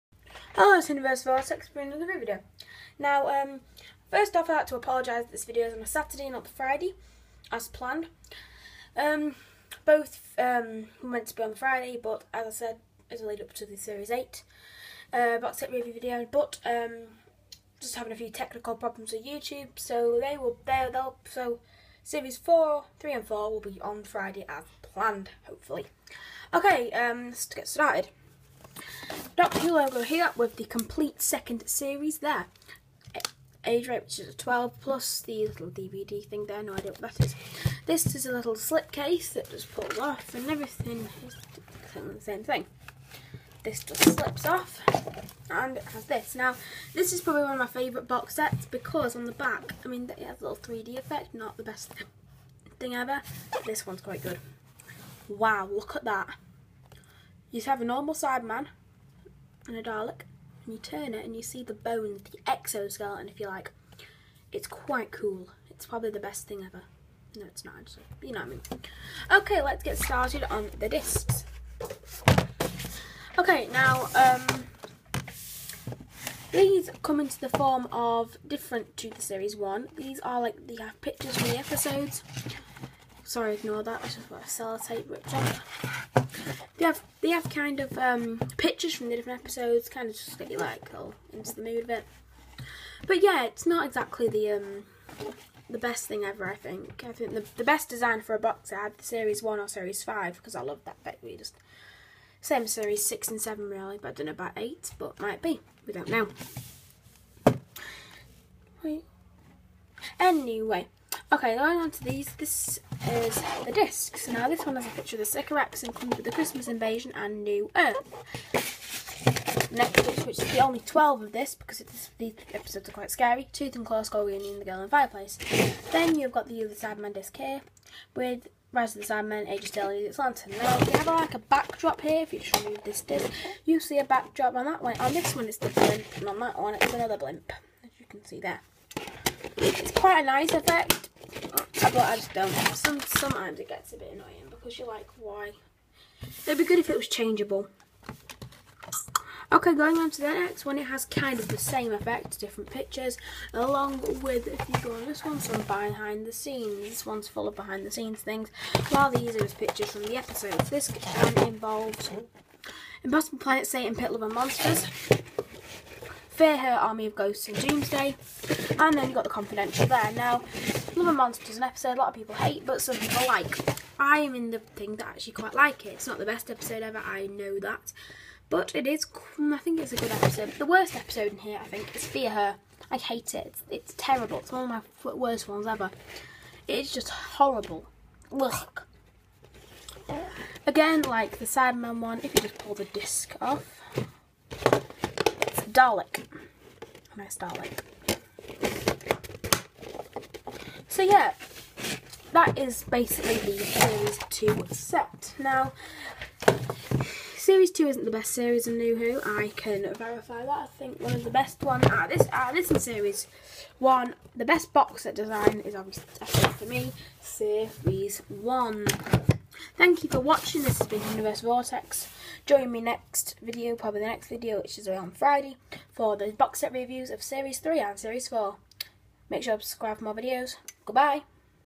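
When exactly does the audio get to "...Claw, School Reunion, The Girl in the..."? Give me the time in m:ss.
2:03.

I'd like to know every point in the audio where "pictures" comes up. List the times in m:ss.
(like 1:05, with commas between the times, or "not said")
1:21, 1:28, 1:54, 2:32, 2:39.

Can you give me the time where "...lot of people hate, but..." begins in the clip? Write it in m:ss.
2:51.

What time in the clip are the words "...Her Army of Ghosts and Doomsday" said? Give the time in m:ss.
2:46.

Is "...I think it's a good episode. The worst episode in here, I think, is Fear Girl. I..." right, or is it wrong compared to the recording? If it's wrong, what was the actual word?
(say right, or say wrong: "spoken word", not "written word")
wrong: "Her", not "Girl".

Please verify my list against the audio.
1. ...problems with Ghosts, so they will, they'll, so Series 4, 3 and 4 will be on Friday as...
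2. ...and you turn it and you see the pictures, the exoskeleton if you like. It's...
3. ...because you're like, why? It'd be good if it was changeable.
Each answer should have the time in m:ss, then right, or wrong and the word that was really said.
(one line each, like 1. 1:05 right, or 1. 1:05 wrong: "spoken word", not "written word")
1. 0:18 wrong: "YouTube", not "Ghosts"
2. 1:00 wrong: "bones", not "pictures"
3. 2:24 right.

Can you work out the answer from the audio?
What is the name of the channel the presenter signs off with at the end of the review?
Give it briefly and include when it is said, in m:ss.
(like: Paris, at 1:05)
Whoniverse Vortex, at 3:40.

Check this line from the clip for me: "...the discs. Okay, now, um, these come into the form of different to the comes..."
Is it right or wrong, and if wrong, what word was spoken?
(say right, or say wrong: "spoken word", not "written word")
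wrong: "series", not "comes".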